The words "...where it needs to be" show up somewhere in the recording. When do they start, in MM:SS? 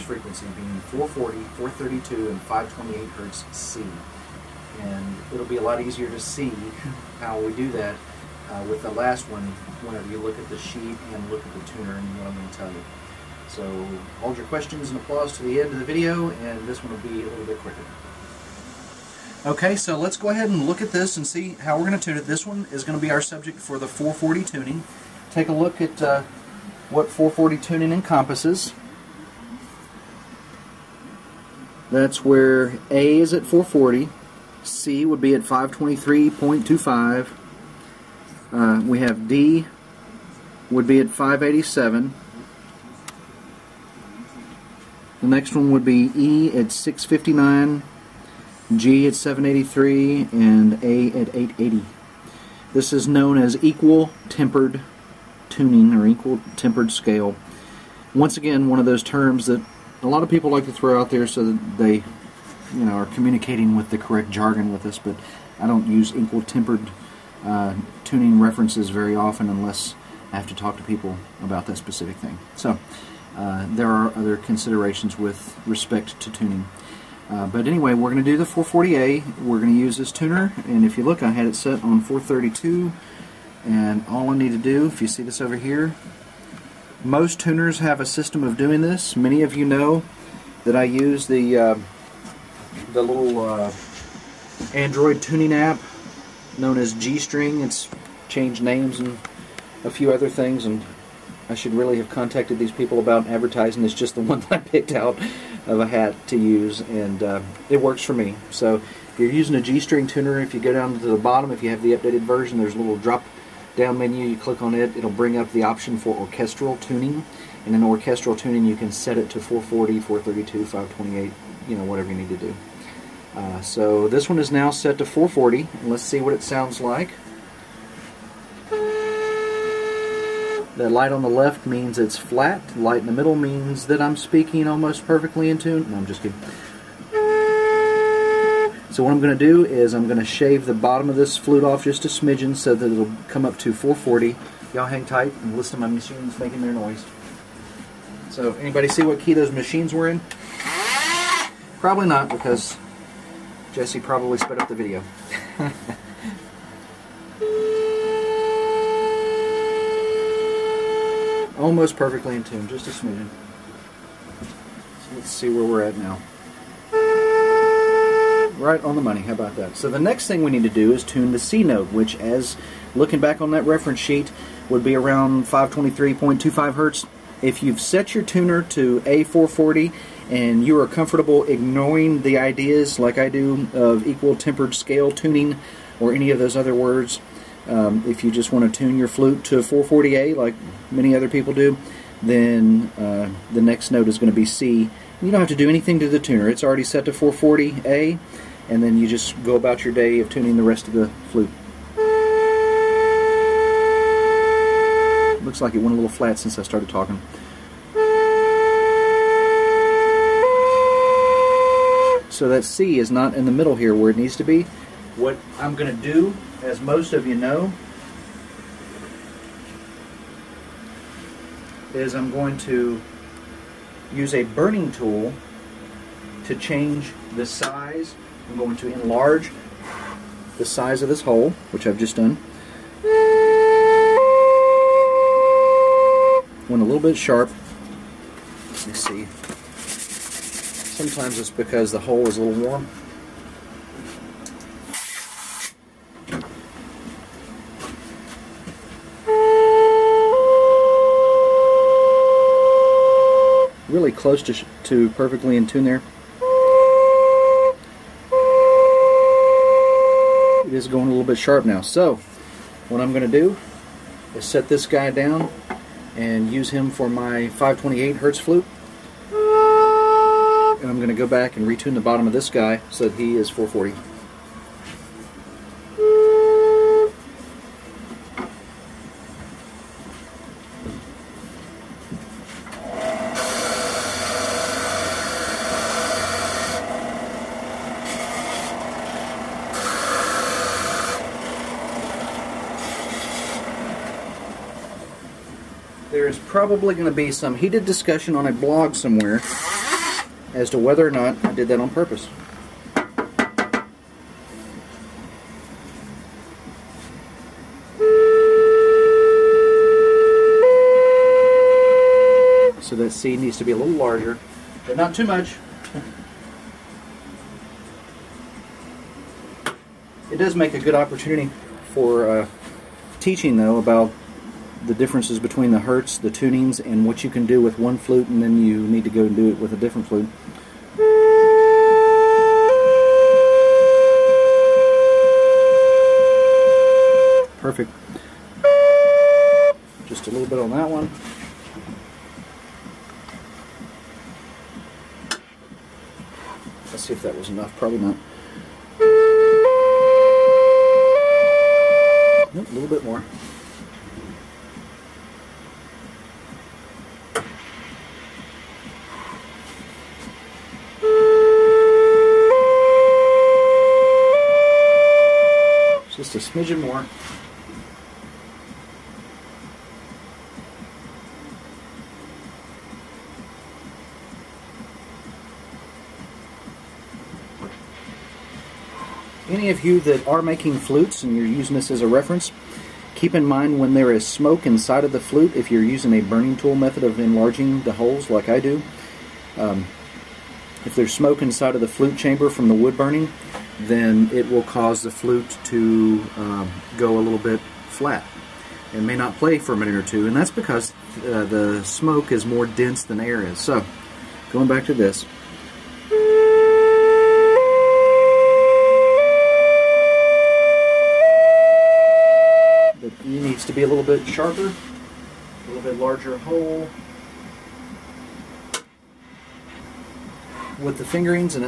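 03:33.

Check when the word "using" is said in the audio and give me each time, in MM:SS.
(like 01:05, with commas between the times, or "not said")
01:49, 06:21, 06:25.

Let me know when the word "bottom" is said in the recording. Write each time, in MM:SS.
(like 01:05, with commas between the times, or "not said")
01:51, 02:20, 04:32.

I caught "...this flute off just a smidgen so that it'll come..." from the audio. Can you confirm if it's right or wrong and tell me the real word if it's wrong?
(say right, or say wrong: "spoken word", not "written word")
right.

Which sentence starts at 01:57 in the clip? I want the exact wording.
And in orchestral tuning, you can set it to 440, 432, 528, you know, whatever you need to do.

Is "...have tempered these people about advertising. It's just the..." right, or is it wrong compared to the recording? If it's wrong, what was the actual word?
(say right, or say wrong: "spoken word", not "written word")
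wrong: "contacted", not "tempered".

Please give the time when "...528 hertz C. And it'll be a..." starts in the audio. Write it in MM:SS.
00:02.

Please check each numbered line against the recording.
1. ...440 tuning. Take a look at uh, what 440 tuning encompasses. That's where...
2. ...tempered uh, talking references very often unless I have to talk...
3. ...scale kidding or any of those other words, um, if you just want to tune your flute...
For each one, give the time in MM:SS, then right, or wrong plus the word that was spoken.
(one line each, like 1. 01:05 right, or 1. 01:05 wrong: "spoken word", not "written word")
1. 00:23 right
2. 01:06 wrong: "tuning", not "talking"
3. 03:04 wrong: "tuning", not "kidding".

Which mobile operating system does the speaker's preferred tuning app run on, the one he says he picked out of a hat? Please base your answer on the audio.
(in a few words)
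Android.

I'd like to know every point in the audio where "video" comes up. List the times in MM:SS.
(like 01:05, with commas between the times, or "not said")
00:15, 02:34.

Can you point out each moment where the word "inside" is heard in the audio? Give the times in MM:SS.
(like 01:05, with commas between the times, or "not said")
06:24, 06:31.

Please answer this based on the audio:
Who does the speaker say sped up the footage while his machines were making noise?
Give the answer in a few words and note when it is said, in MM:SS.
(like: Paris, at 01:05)
Jesse, at 02:33.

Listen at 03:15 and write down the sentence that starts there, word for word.
You don't have to do anything to the tuner.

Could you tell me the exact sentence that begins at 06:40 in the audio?
And that's because uh, the smoke is more dense than air is.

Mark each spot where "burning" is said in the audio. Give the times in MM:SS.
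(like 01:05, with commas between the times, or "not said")
03:44, 06:26, 06:32.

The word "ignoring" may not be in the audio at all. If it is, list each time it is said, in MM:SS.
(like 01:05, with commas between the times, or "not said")
03:01.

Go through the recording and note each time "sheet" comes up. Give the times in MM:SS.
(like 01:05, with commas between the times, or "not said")
00:10, 02:53.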